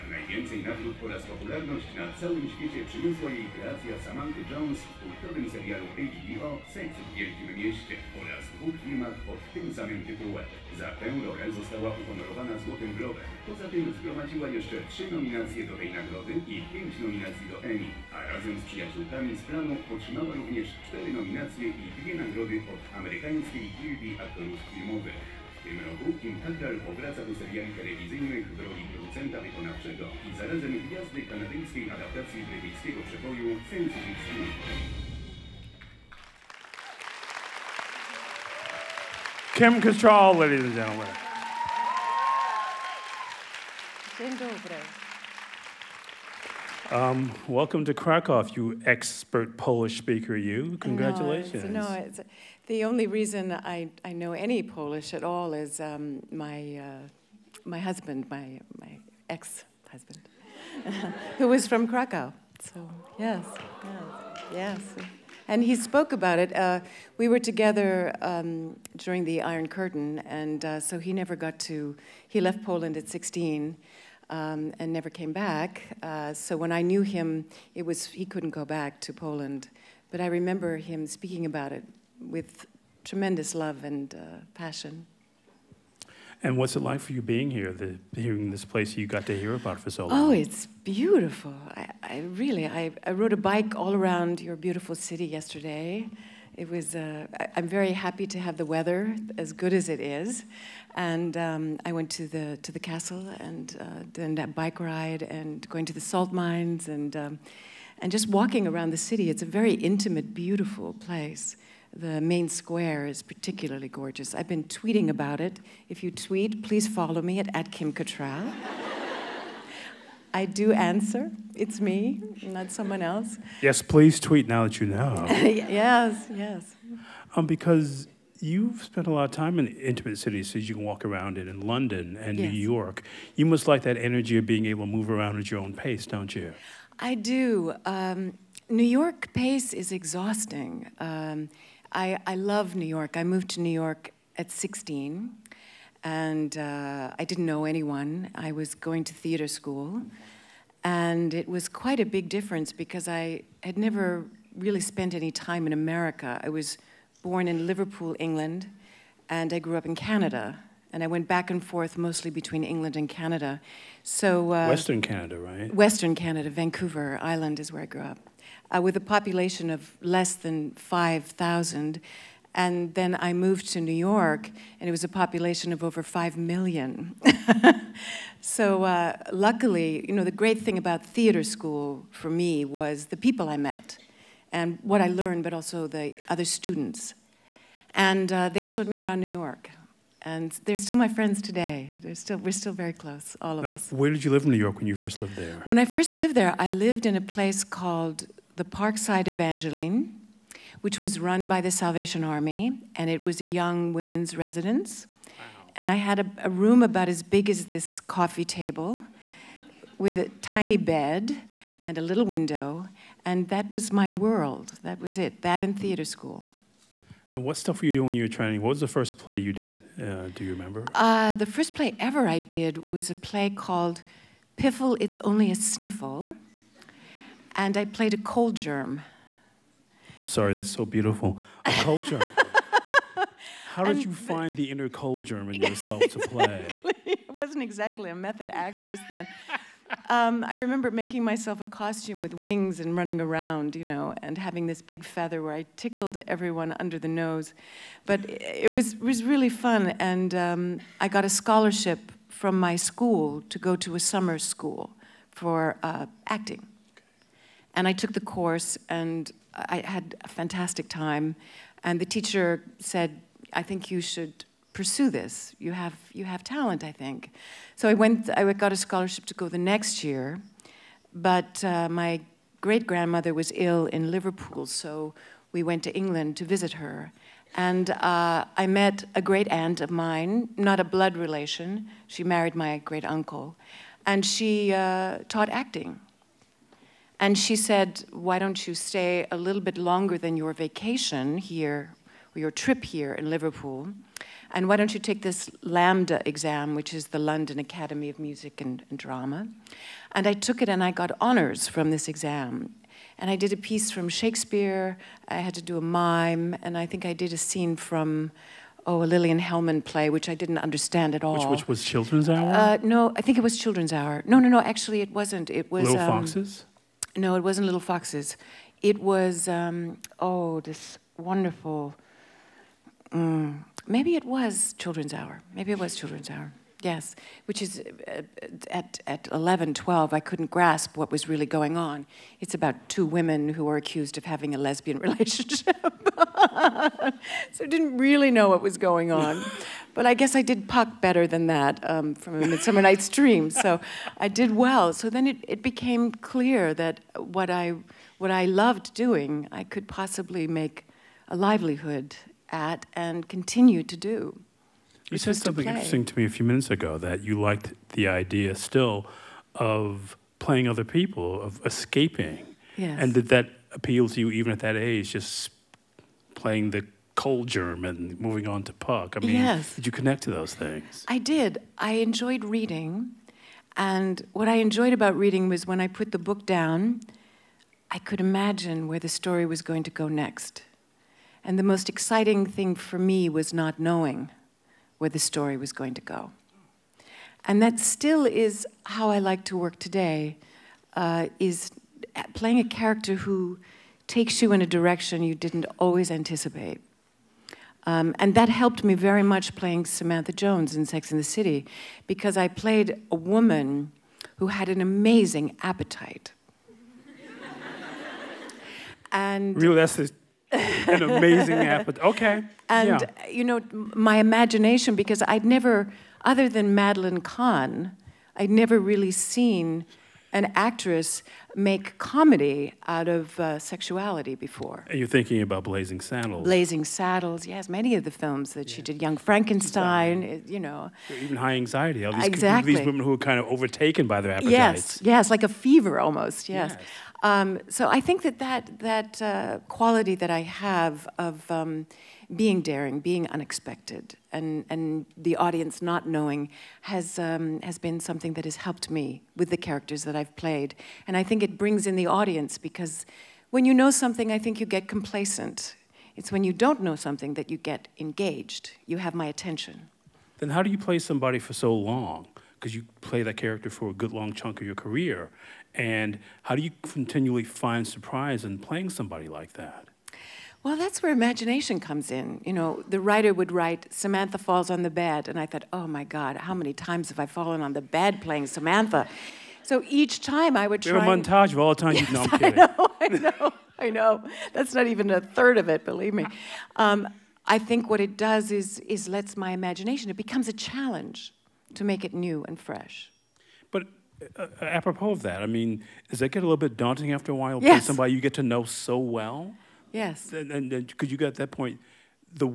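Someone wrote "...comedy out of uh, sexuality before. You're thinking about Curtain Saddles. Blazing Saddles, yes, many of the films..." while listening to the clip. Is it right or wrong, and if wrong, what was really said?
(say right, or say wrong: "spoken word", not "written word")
wrong: "Blazing", not "Curtain".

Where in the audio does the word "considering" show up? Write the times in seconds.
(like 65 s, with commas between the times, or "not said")
not said.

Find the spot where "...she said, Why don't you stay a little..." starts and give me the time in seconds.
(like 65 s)
287 s.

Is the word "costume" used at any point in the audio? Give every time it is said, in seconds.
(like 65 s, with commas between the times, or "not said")
241 s.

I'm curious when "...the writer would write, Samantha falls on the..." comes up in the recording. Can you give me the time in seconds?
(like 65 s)
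472 s.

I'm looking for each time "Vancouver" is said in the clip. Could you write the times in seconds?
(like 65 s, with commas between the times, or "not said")
166 s.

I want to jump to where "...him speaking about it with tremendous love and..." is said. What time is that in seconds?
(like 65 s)
80 s.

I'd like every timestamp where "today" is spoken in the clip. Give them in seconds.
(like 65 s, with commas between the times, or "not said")
191 s, 389 s.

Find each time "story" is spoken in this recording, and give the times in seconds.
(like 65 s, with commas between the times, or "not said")
379 s, 385 s.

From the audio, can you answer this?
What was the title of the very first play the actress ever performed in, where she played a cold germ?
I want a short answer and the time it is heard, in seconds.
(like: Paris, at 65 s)
Piffle, It's Only a Sniffle, at 224 s.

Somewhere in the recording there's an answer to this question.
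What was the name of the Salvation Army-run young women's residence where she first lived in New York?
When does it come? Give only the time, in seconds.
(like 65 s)
198 s.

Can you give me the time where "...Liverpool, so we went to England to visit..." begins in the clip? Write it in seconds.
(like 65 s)
274 s.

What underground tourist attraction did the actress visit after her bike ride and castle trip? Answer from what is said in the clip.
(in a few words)
salt mines.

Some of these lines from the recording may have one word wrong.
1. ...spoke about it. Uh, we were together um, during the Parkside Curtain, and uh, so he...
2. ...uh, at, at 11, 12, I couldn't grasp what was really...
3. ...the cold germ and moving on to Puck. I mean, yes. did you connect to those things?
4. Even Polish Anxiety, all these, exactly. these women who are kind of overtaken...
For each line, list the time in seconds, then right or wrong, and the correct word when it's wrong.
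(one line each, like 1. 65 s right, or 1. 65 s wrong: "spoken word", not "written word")
1. 65 s wrong: "Iron", not "Parkside"
2. 328 s right
3. 366 s right
4. 431 s wrong: "High", not "Polish".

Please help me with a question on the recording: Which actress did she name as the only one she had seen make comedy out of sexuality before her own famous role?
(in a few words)
Madeline Kahn.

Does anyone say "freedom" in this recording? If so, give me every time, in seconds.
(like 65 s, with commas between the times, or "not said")
not said.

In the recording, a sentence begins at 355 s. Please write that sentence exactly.
You said something interesting to me a few minutes ago that you liked the idea still of playing other people, of escaping.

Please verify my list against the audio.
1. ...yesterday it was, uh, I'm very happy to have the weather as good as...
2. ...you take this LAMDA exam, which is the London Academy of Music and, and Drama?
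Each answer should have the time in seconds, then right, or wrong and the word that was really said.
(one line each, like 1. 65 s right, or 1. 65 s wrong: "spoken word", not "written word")
1. 95 s right
2. 294 s right.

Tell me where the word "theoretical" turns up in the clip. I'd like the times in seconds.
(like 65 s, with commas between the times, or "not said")
not said.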